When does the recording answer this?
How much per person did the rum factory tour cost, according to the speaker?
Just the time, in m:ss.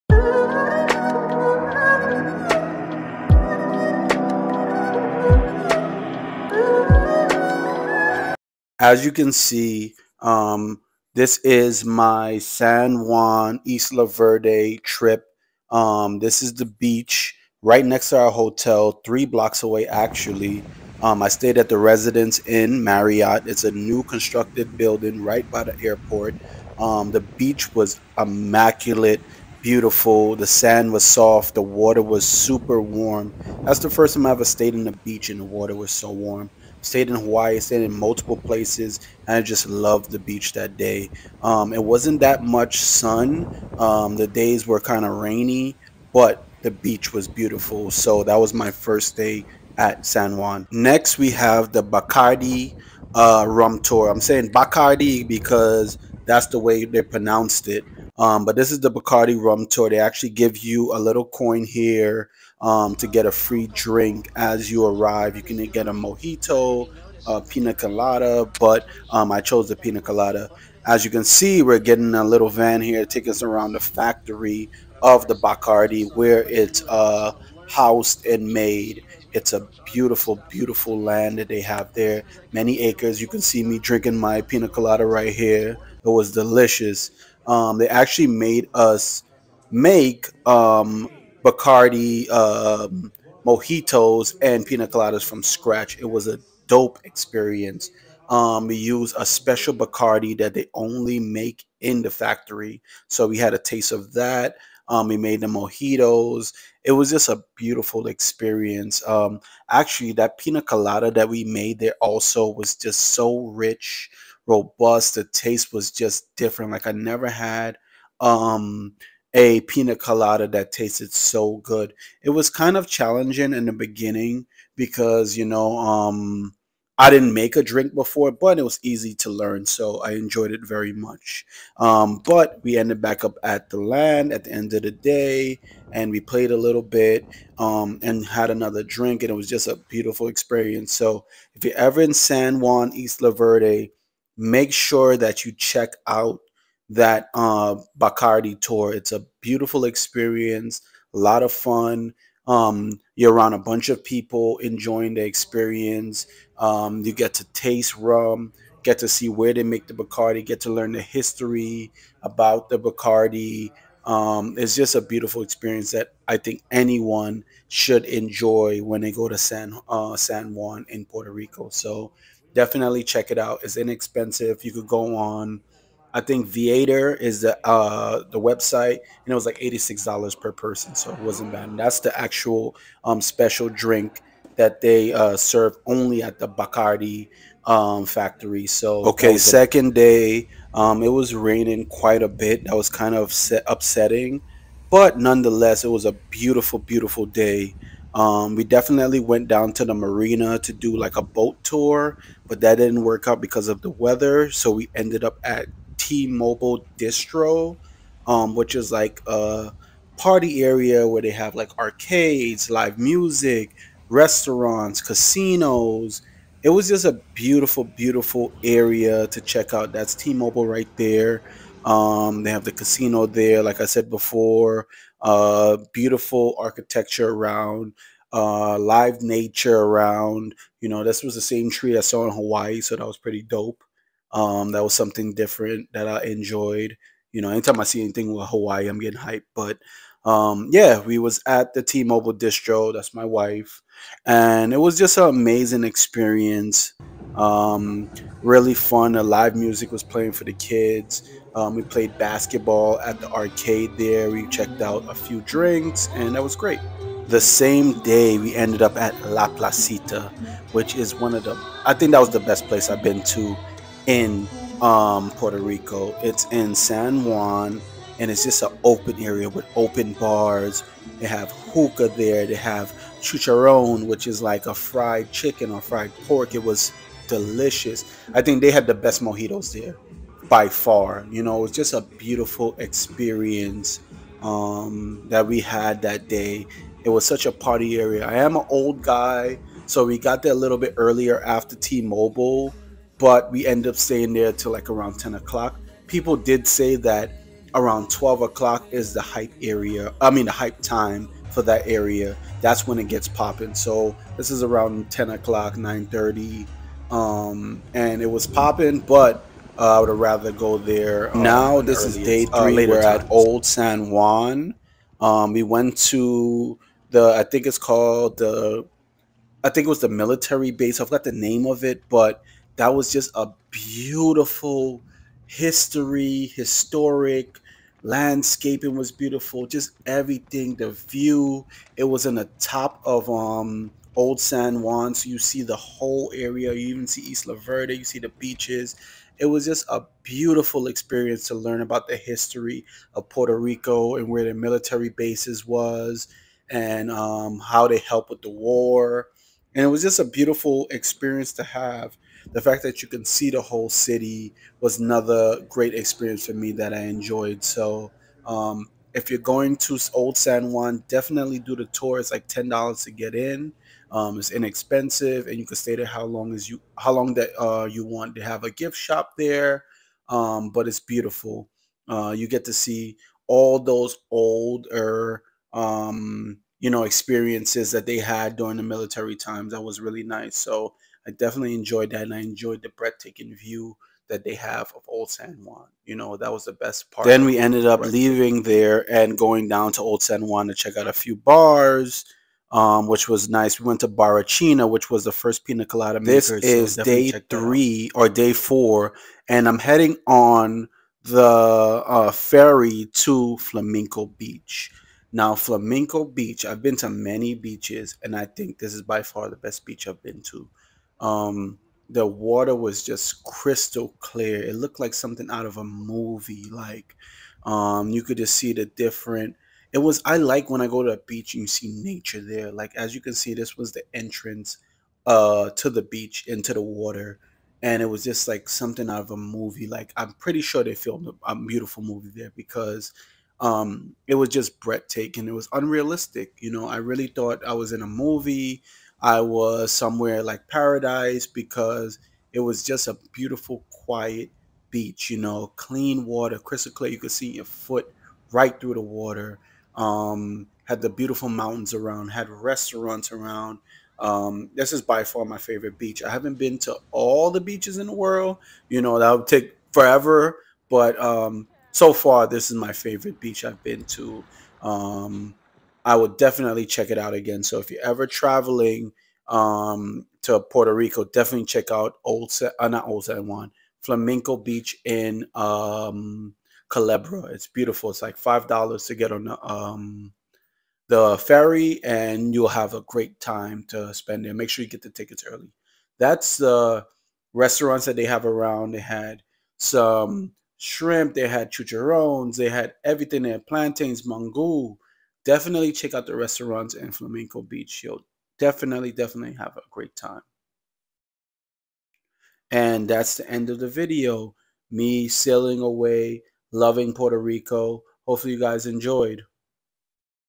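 2:59.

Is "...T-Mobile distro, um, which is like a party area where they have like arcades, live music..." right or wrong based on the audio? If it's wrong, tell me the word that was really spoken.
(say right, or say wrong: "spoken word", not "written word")
right.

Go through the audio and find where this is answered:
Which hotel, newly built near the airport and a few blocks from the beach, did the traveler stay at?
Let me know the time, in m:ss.
0:21.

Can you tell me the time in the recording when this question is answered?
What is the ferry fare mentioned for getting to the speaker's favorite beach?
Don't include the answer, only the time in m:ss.
7:58.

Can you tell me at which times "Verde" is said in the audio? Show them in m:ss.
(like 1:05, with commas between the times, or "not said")
0:14, 2:23, 5:37.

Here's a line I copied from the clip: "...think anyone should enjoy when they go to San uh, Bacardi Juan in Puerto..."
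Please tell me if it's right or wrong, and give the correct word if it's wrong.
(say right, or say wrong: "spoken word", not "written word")
wrong: "San", not "Bacardi".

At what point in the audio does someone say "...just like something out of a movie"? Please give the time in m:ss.
7:08.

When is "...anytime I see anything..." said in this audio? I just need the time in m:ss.
3:57.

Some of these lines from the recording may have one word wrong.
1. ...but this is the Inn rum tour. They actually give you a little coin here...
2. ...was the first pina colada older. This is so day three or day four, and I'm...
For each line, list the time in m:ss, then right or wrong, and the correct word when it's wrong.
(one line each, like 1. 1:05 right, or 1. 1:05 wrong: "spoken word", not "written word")
1. 0:58 wrong: "Bacardi", not "Inn"
2. 6:35 wrong: "maker", not "older".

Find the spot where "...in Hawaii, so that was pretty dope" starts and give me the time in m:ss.
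3:52.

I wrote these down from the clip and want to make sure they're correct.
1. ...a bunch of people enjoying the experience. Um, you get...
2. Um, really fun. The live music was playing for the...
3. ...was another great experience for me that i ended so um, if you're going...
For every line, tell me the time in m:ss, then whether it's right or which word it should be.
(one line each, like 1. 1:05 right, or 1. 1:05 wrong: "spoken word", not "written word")
1. 2:33 right
2. 4:07 right
3. 5:54 wrong: "enjoyed", not "ended".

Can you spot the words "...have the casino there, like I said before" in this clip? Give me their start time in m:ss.
3:42.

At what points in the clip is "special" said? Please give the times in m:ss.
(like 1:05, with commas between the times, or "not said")
1:39, 3:03.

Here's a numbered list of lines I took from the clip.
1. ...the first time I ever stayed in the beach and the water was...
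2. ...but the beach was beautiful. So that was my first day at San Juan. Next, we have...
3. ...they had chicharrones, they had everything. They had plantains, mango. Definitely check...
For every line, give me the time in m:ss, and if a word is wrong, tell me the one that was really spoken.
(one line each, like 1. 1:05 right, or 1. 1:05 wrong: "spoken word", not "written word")
1. 0:33 right
2. 0:46 right
3. 8:11 right.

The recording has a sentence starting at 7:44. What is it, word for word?
Um, I would definitely check it out again.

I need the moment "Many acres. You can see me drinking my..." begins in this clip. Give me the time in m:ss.
1:22.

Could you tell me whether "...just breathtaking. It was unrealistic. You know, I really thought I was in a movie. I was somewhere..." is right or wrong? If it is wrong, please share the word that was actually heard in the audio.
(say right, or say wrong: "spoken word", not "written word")
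right.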